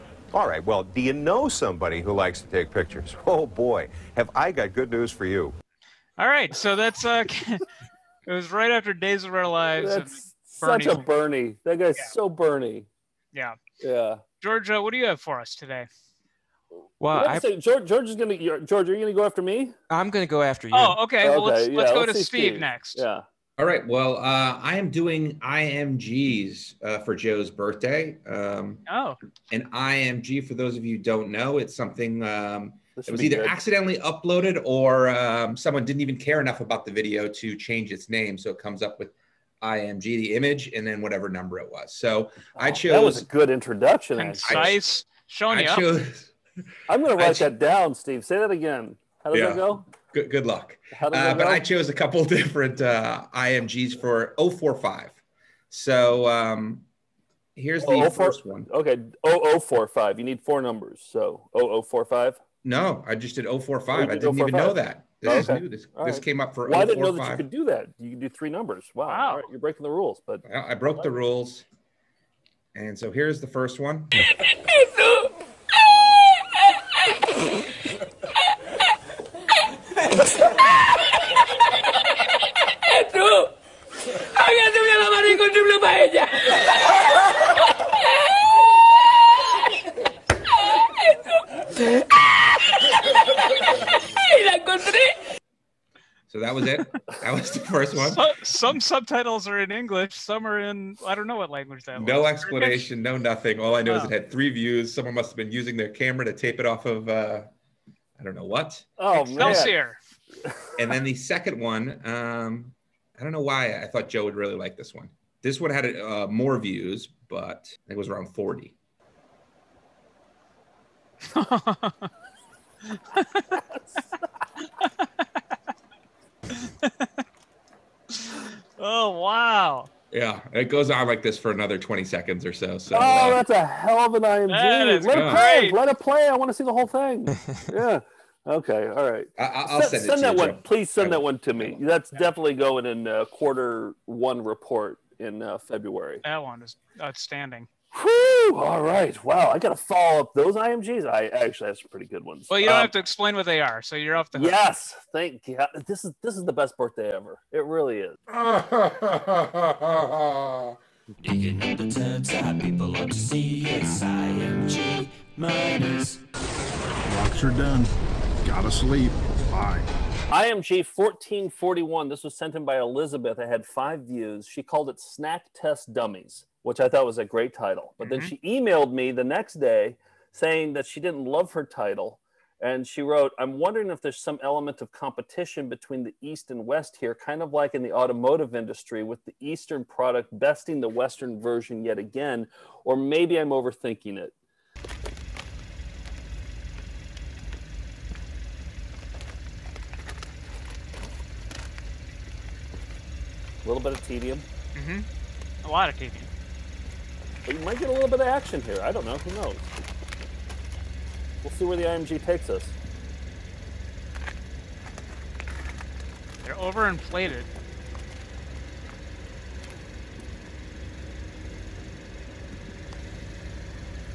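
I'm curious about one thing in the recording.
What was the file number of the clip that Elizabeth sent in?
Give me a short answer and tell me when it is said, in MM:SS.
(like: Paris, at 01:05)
1441, at 02:50.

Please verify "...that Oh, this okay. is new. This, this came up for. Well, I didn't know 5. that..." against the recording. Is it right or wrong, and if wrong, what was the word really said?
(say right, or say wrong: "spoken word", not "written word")
right.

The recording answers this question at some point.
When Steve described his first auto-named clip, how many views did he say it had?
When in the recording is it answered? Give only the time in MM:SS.
01:44.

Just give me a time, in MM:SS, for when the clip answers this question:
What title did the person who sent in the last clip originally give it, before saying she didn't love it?
02:54.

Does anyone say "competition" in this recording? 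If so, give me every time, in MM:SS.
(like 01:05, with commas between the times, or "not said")
03:04.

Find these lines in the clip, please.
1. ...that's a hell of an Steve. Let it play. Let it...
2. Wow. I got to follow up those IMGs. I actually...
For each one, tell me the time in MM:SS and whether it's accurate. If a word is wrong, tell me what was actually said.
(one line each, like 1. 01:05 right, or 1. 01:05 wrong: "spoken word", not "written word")
1. 02:13 wrong: "IMG", not "Steve"
2. 02:29 right.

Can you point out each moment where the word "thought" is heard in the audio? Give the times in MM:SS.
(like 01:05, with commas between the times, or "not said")
01:53, 02:56.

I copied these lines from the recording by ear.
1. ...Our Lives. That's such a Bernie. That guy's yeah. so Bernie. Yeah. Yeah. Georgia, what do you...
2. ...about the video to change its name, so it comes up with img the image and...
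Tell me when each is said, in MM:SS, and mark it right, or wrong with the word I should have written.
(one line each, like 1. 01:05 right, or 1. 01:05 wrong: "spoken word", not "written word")
1. 00:09 right
2. 00:36 right.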